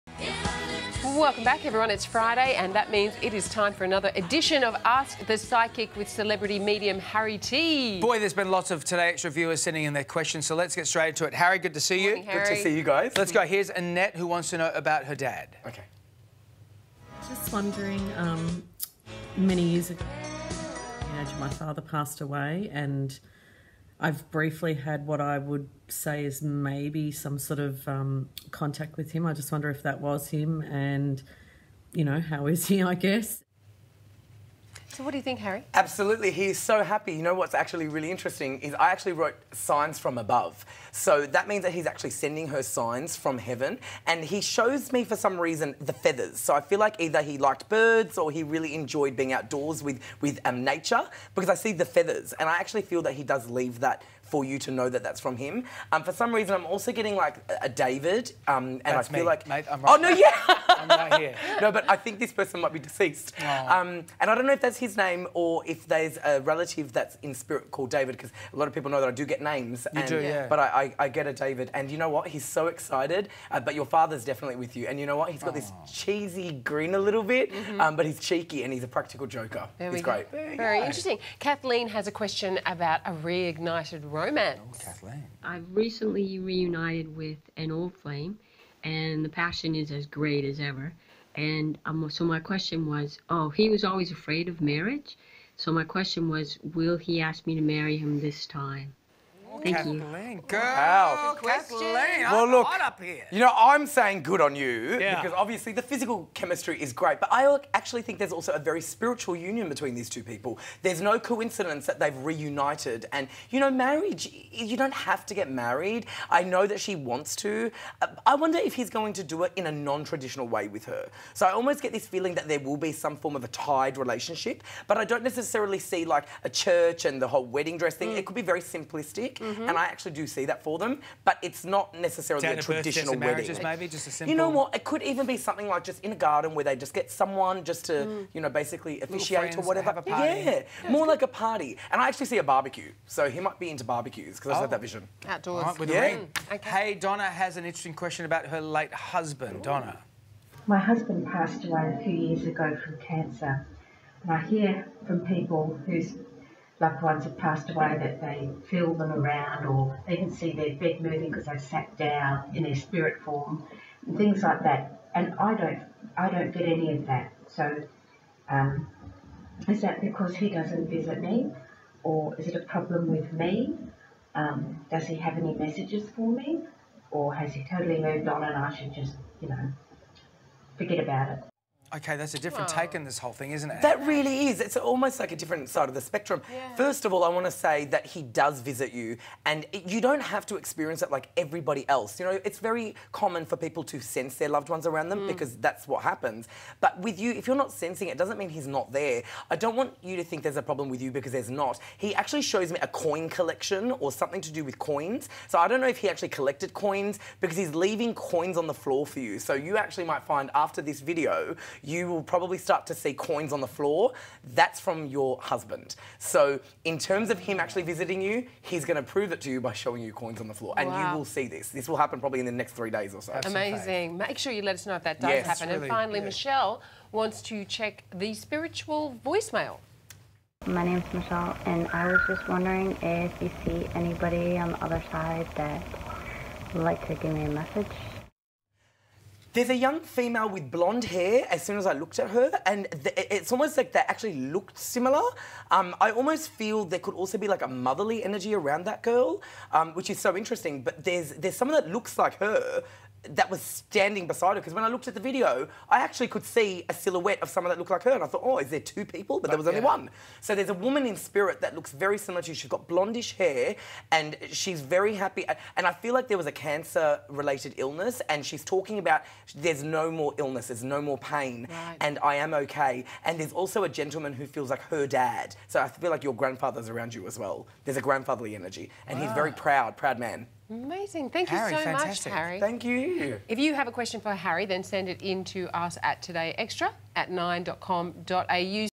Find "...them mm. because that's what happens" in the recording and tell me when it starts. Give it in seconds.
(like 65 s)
195 s.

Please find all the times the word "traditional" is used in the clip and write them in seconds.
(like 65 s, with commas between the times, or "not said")
119 s, 132 s.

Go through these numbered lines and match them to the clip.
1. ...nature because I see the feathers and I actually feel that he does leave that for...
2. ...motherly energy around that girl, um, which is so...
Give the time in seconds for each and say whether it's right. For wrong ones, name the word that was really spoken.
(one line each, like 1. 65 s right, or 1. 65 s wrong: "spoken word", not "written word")
1. 50 s right
2. 247 s right.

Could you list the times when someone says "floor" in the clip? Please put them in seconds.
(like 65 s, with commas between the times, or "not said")
208 s, 213 s, 220 s.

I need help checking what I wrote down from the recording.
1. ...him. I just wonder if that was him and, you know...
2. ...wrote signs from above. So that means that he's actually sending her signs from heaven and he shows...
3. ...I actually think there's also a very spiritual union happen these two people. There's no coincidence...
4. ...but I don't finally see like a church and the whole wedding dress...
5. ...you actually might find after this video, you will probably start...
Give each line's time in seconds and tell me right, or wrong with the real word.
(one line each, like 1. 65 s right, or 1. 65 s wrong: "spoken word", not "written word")
1. 29 s right
2. 39 s right
3. 107 s wrong: "between", not "happen"
4. 124 s wrong: "necessarily", not "finally"
5. 209 s right.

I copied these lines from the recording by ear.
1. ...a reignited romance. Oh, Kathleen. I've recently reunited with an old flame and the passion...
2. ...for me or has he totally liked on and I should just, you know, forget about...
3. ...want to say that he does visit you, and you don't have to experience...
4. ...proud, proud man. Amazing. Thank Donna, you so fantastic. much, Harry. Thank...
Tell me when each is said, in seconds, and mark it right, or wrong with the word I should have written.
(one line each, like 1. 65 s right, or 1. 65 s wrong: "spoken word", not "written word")
1. 83 s right
2. 176 s wrong: "moved", not "liked"
3. 187 s right
4. 279 s wrong: "Harry", not "Donna".